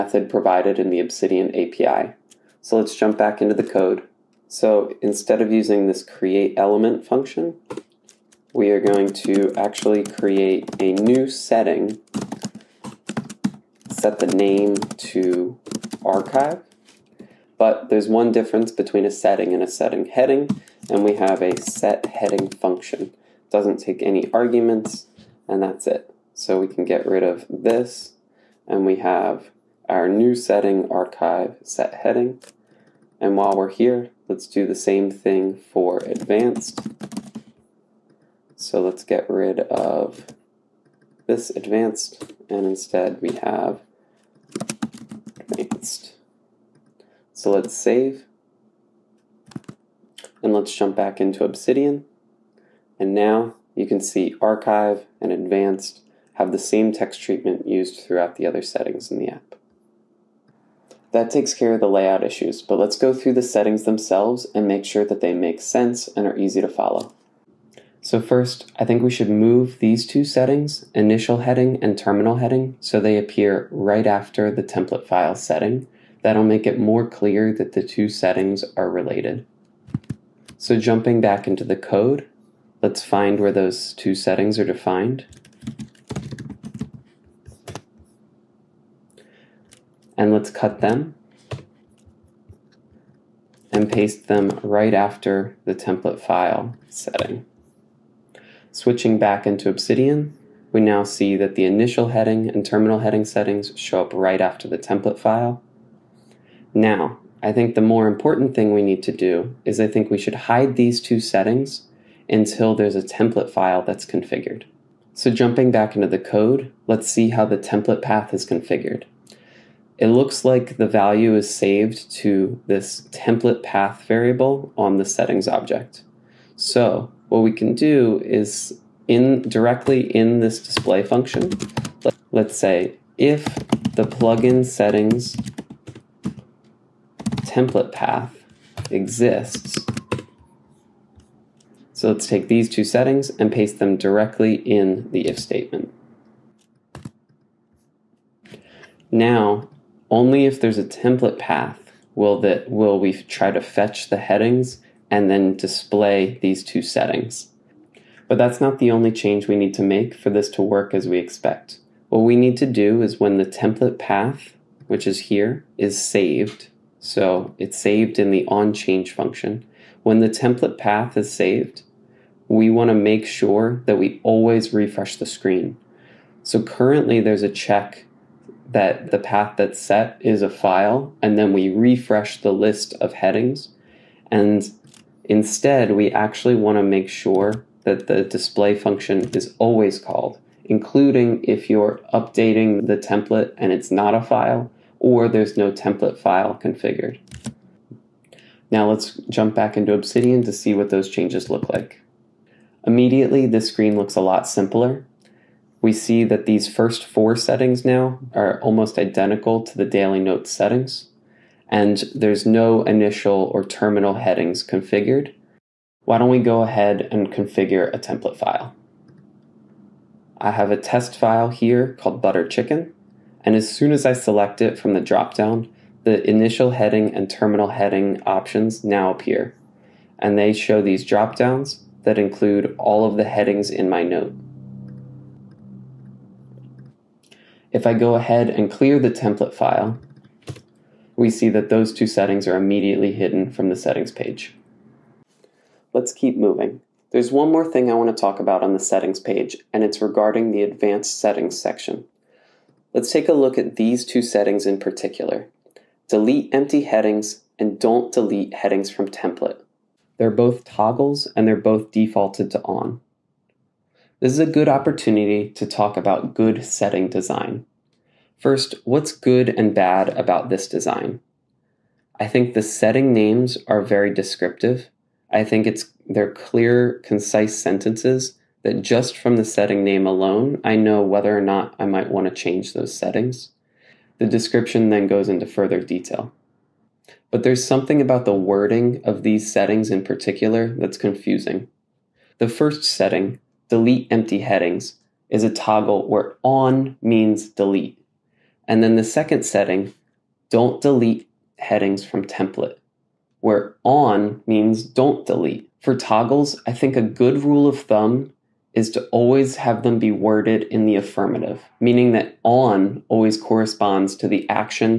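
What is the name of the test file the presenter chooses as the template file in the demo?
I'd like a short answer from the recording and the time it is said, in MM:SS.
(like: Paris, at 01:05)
butter chicken, at 03:42.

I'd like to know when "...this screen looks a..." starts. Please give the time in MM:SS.
03:23.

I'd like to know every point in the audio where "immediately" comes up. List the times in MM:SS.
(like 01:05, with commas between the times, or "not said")
03:22, 04:02.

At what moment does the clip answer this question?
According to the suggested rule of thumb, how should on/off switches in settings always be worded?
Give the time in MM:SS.
05:10.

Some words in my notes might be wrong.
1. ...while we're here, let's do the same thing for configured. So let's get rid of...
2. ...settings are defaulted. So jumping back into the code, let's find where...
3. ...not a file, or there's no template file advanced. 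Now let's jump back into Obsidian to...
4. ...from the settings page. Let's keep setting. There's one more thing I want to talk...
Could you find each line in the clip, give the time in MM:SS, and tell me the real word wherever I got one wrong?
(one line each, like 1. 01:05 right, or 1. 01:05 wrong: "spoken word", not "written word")
1. 00:33 wrong: "advanced", not "configured"
2. 01:18 wrong: "related", not "defaulted"
3. 03:13 wrong: "configured", not "advanced"
4. 04:03 wrong: "moving", not "setting".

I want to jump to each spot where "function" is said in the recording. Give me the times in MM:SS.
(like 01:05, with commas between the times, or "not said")
00:07, 00:22, 02:11, 02:49, 03:08.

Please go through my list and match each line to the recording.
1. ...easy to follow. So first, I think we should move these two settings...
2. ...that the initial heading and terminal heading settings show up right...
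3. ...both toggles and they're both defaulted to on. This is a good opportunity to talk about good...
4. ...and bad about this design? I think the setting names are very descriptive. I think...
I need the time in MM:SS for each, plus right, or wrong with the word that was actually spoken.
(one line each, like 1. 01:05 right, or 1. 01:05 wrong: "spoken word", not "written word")
1. 01:06 right
2. 01:41 right
3. 04:20 right
4. 04:29 right.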